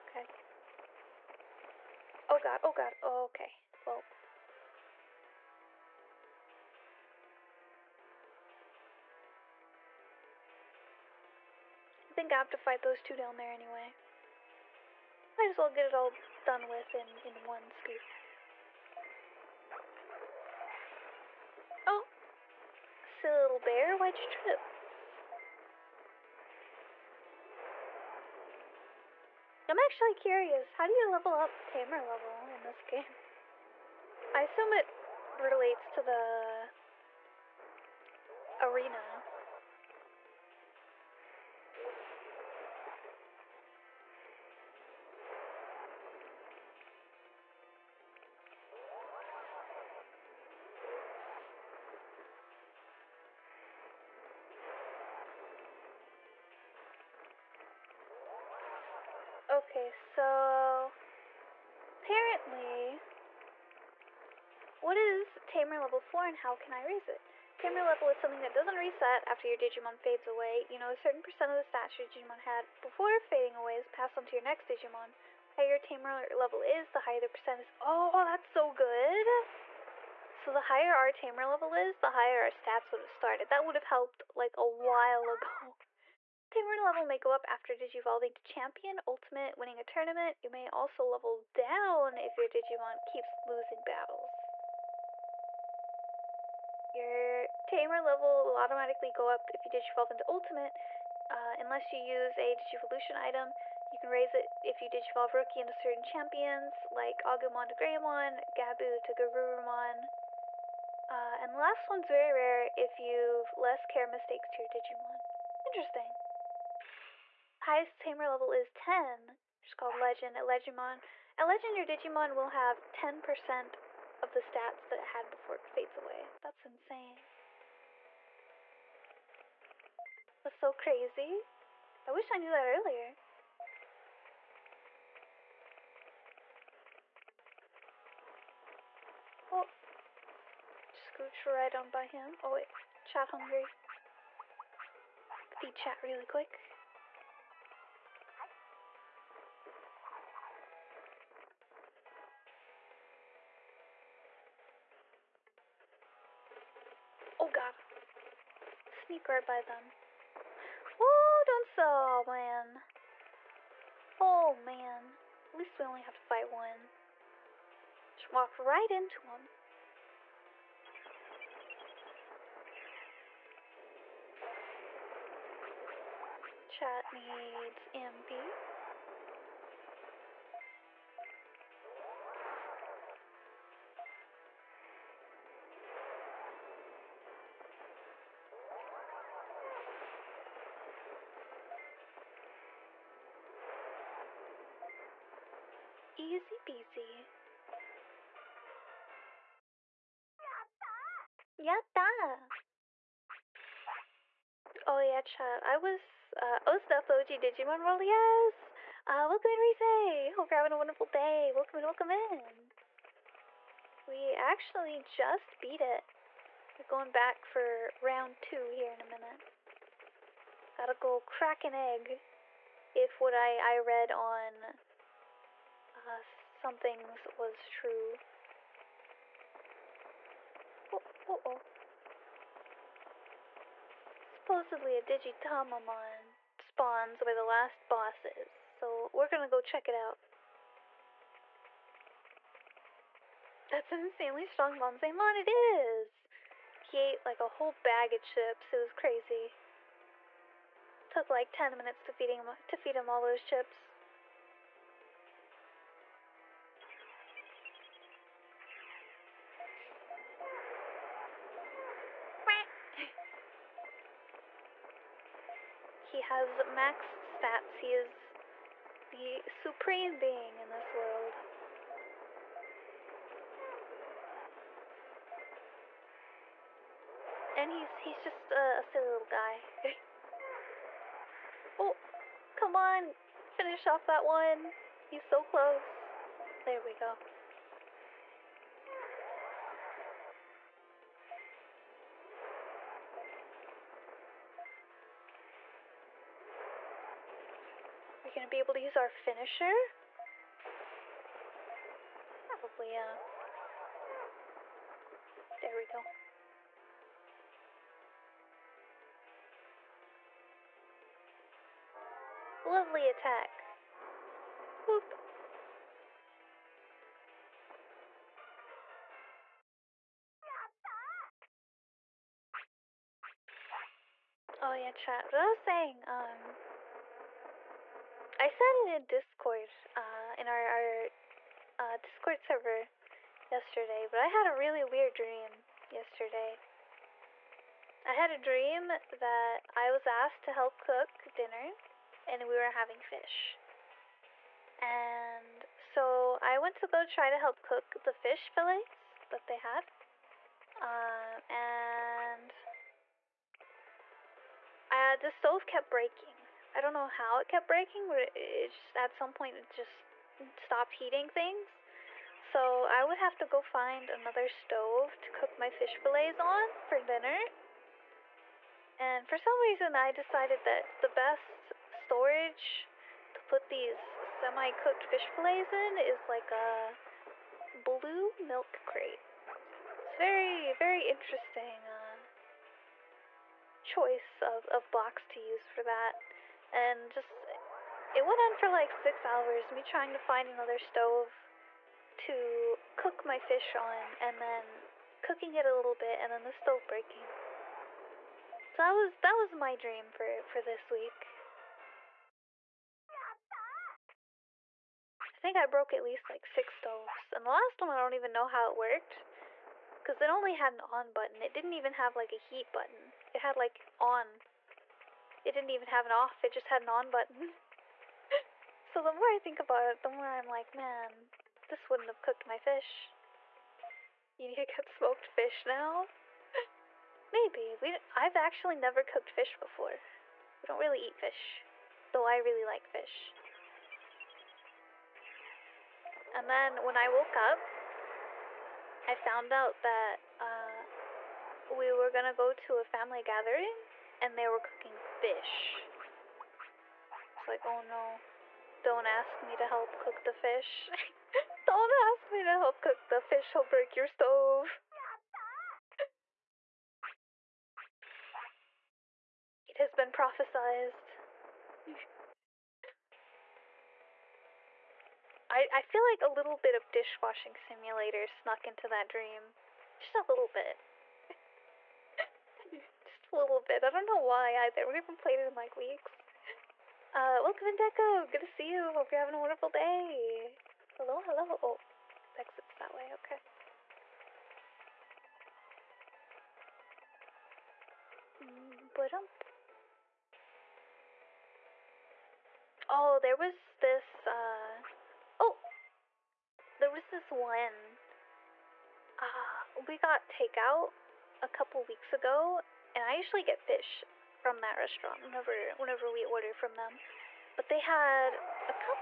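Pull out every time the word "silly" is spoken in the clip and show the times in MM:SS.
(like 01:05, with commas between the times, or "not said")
00:23, 04:38.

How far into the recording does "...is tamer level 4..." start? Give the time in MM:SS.
01:04.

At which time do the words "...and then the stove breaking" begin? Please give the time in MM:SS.
06:36.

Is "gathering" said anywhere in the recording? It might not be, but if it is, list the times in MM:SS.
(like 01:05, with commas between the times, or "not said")
07:23.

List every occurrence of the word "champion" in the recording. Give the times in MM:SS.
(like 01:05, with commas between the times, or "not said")
01:28, 01:46.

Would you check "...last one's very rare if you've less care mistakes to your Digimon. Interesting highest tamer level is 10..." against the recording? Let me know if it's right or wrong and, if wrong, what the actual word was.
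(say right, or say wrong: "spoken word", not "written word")
right.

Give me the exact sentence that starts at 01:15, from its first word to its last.
The higher tamer level is, the higher the percent is.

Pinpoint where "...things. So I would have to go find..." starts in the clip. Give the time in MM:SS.
06:01.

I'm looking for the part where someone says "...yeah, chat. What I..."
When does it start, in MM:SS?
05:24.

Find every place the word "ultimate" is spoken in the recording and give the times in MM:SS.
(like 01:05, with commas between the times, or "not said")
01:29, 01:40.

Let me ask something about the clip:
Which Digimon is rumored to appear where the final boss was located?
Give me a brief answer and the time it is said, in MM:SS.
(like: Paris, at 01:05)
Digitamamon, at 03:55.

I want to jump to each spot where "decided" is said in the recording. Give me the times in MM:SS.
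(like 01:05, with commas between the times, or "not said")
06:10.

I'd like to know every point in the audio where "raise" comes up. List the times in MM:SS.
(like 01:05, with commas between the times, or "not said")
01:06, 01:44.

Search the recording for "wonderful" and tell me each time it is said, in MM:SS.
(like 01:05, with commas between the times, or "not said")
03:30, 07:59.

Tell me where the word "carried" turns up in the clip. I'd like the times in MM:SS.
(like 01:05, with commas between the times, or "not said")
not said.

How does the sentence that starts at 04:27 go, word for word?
He is the supreme being in this world.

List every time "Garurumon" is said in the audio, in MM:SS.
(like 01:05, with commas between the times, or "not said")
01:49.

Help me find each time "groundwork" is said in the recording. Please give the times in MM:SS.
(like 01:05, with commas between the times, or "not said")
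not said.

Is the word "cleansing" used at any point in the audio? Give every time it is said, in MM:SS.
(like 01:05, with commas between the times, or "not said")
not said.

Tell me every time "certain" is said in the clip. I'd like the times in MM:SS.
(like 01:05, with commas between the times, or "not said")
01:10, 01:45.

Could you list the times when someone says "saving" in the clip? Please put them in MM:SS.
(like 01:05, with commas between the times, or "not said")
not said.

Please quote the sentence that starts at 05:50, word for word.
Um, and uh, the stove kept breaking.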